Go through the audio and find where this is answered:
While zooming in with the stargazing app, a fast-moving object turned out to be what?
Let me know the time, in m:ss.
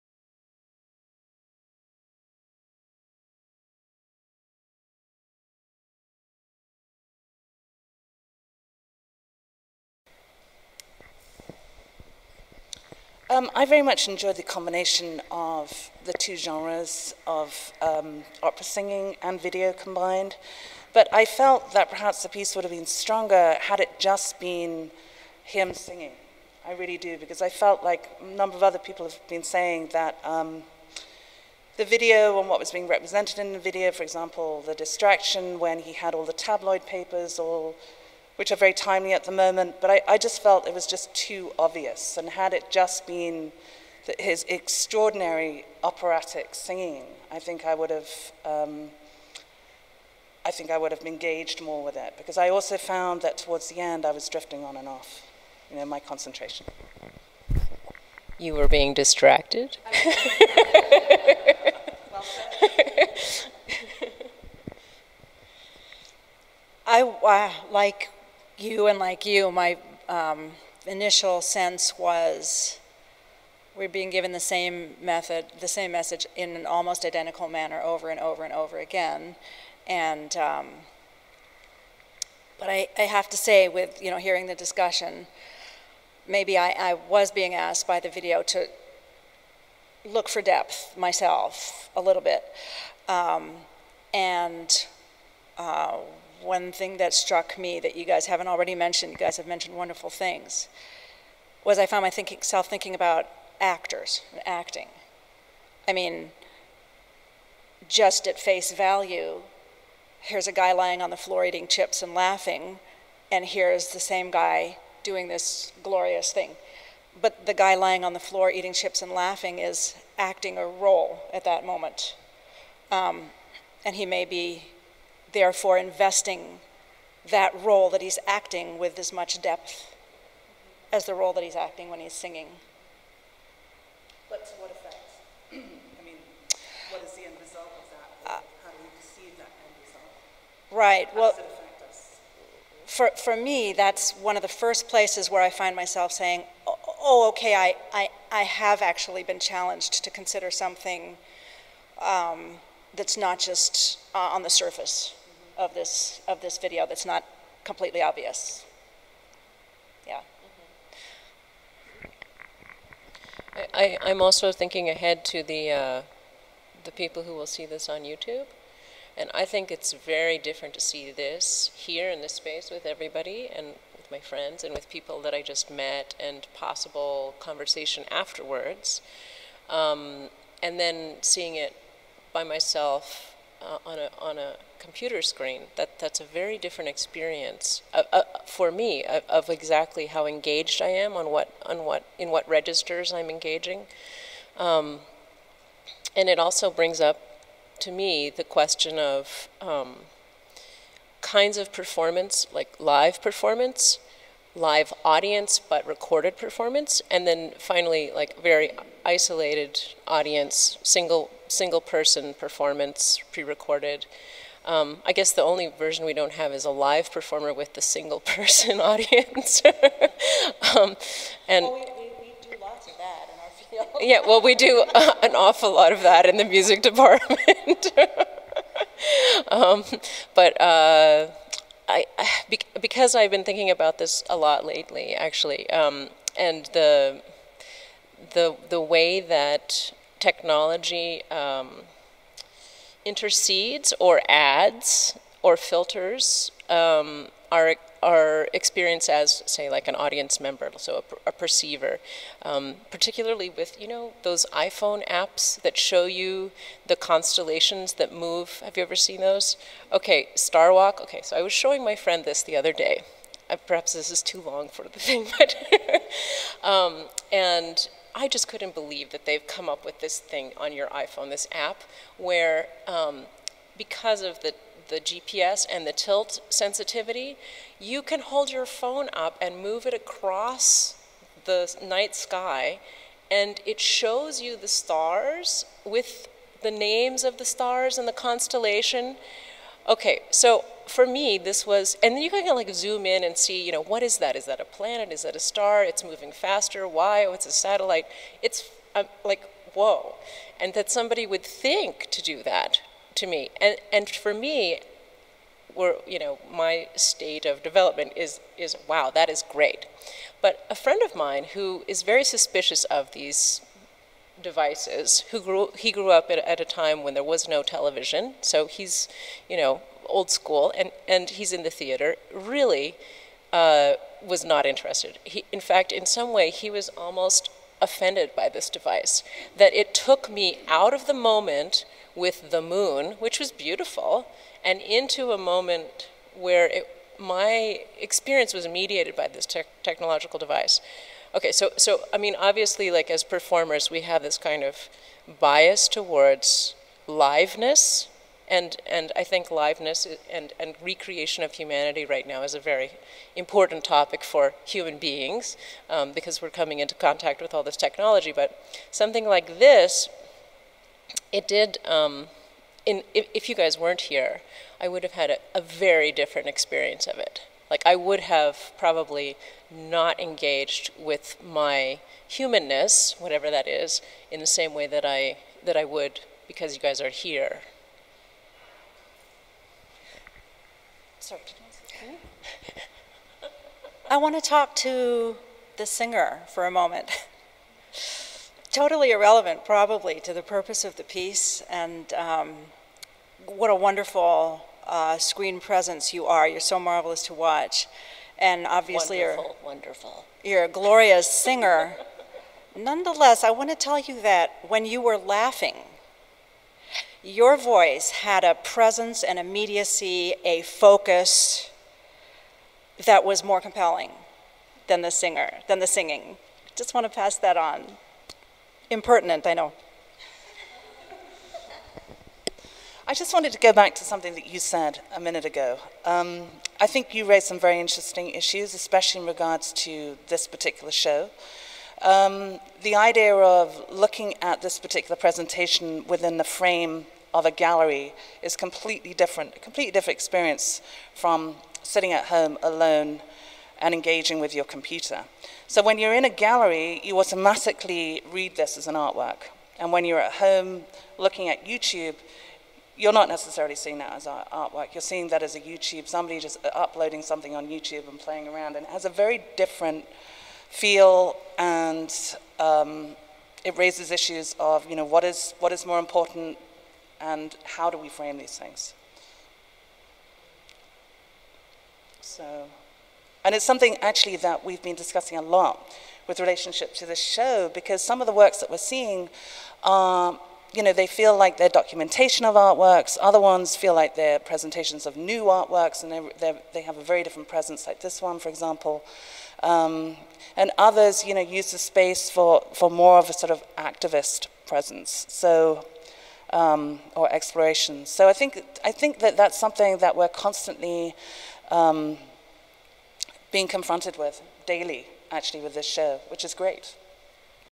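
4:57.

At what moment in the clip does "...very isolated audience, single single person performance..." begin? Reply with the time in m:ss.
3:28.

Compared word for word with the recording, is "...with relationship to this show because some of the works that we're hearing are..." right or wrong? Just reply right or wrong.
wrong.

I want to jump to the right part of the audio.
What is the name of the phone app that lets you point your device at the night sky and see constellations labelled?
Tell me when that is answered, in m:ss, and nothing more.
4:20.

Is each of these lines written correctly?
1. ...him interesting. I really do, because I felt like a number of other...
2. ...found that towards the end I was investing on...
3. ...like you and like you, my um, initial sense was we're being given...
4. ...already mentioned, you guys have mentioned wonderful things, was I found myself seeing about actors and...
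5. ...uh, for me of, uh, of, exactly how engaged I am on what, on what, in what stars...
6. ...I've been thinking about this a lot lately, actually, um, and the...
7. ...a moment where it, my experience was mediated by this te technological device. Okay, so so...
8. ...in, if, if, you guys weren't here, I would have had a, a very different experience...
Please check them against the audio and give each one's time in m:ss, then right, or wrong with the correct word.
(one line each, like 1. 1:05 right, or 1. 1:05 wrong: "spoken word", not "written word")
1. 0:25 wrong: "singing", not "interesting"
2. 0:52 wrong: "drifting", not "investing"
3. 1:07 right
4. 1:38 wrong: "thinking", not "seeing"
5. 3:08 wrong: "registers", not "stars"
6. 3:53 right
7. 5:35 right
8. 6:02 right.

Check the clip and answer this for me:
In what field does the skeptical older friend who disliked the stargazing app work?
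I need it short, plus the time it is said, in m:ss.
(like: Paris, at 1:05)
Theater, at 5:21.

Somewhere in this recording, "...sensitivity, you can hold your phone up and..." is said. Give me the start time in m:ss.
4:36.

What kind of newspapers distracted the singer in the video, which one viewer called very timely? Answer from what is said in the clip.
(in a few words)
Tabloid papers.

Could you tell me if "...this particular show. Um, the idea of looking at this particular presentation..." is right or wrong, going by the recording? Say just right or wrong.
right.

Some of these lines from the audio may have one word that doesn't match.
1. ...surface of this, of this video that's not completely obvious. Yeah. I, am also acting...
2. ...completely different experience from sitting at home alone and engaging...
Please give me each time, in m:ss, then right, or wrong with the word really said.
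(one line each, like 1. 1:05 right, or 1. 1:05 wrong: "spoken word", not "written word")
1. 2:34 wrong: "thinking", not "acting"
2. 7:19 right.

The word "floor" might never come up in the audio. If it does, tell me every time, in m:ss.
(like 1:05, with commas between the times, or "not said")
1:51, 1:58.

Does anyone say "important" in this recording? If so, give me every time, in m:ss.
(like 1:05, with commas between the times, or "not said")
5:53, 7:45.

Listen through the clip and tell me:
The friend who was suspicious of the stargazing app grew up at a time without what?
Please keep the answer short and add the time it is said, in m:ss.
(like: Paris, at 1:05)
Television, at 5:17.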